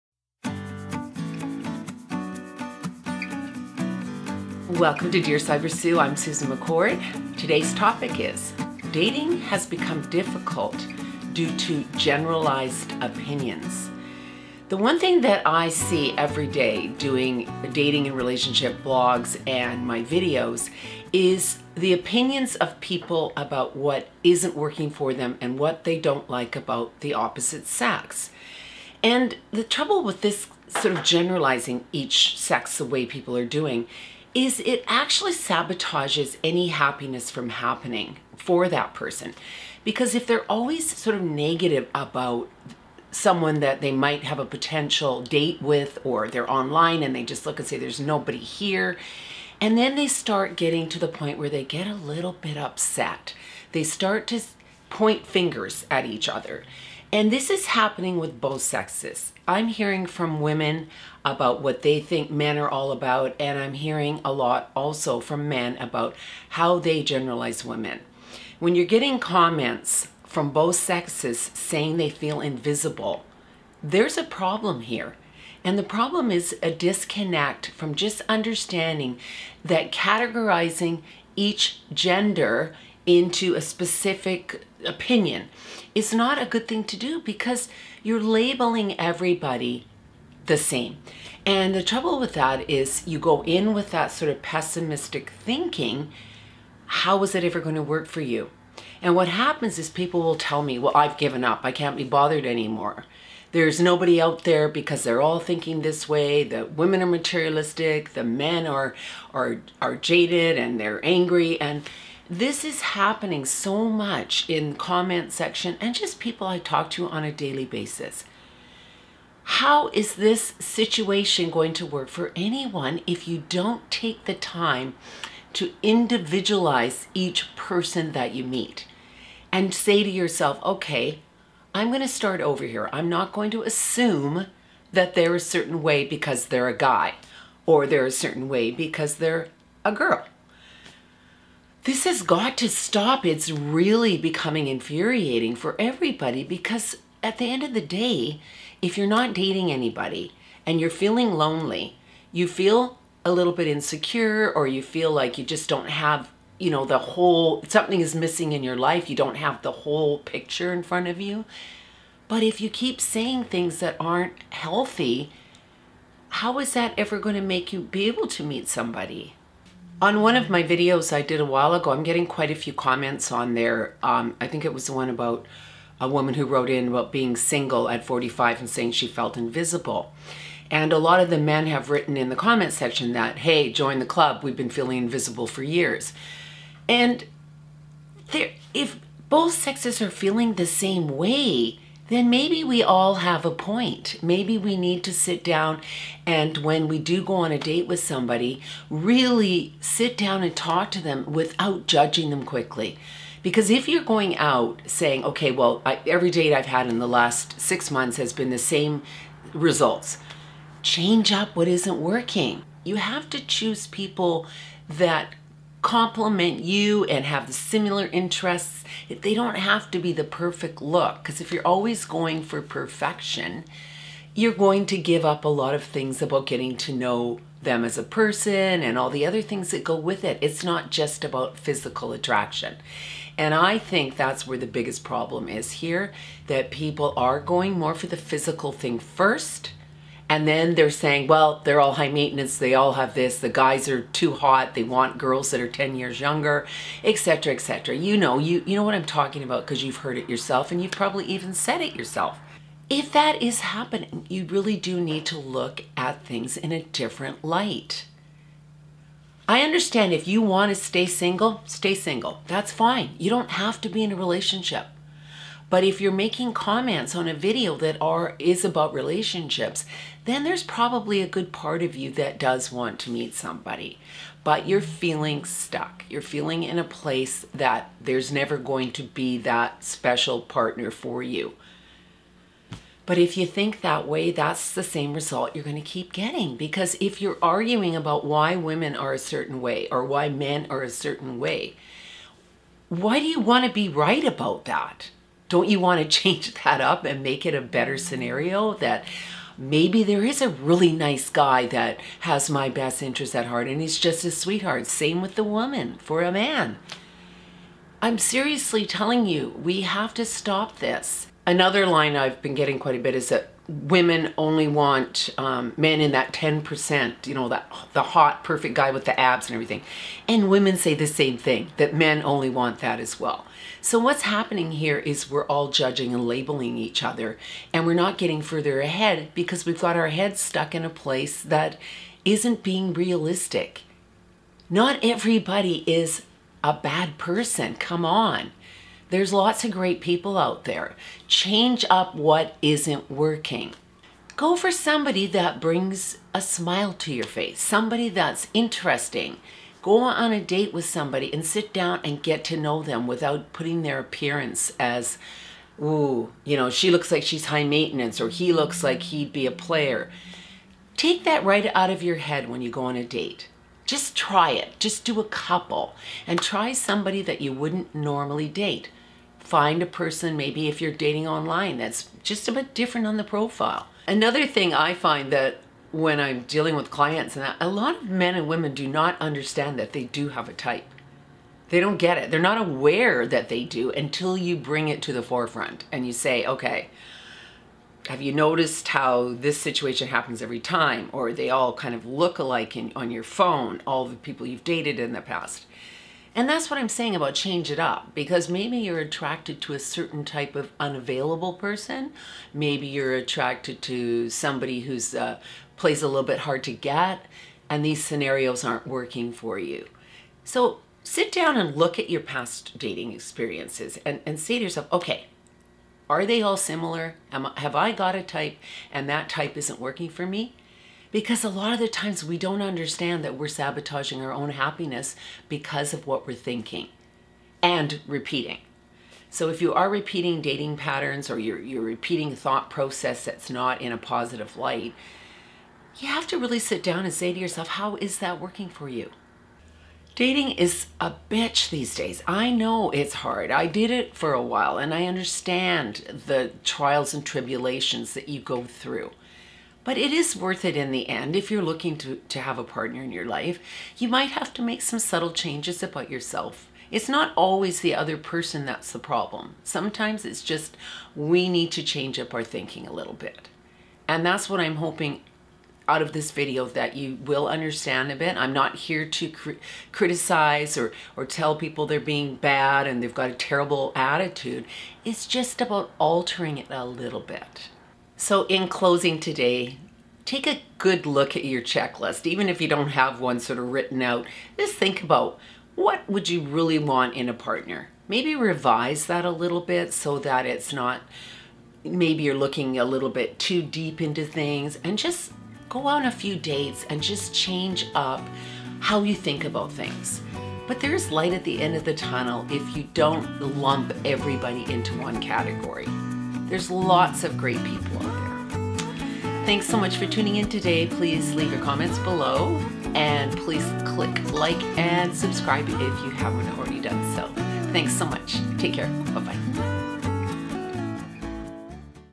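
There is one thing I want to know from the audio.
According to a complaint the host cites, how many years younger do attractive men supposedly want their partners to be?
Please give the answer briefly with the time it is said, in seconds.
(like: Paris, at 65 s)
10, at 245 s.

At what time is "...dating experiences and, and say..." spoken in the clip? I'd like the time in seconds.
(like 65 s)
412 s.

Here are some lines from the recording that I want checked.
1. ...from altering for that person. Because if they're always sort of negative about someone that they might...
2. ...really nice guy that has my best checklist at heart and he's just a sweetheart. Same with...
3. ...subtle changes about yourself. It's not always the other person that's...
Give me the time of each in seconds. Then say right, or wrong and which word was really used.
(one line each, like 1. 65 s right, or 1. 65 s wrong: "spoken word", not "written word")
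1. 37 s wrong: "happening", not "altering"
2. 300 s wrong: "interest", not "checklist"
3. 454 s right.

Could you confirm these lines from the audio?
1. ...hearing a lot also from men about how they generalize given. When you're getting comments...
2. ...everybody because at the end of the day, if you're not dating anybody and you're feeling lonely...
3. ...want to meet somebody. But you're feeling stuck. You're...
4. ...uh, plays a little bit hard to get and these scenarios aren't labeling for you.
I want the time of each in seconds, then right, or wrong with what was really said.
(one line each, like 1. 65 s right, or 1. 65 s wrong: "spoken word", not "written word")
1. 63 s wrong: "women", not "given"
2. 145 s right
3. 272 s right
4. 405 s wrong: "working", not "labeling".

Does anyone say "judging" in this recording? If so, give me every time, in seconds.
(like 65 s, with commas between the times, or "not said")
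201 s, 325 s.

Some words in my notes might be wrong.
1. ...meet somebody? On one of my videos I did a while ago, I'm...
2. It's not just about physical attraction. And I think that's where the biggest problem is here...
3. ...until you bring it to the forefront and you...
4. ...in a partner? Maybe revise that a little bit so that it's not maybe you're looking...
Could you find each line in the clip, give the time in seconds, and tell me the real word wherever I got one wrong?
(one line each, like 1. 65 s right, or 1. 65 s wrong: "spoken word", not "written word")
1. 168 s right
2. 230 s right
3. 383 s right
4. 487 s right.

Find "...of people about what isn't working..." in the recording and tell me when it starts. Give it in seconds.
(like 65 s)
22 s.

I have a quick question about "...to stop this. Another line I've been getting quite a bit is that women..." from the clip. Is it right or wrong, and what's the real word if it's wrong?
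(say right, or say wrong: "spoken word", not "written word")
right.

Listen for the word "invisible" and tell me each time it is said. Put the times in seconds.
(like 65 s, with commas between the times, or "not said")
72 s, 179 s, 184 s.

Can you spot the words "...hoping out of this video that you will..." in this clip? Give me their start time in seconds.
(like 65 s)
464 s.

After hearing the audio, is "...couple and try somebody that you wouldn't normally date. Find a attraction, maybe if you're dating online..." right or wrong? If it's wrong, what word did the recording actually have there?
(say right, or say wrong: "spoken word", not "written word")
wrong: "person", not "attraction".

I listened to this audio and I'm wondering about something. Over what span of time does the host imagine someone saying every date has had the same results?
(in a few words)
six months.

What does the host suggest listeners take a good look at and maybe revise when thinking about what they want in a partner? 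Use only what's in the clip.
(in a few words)
checklist.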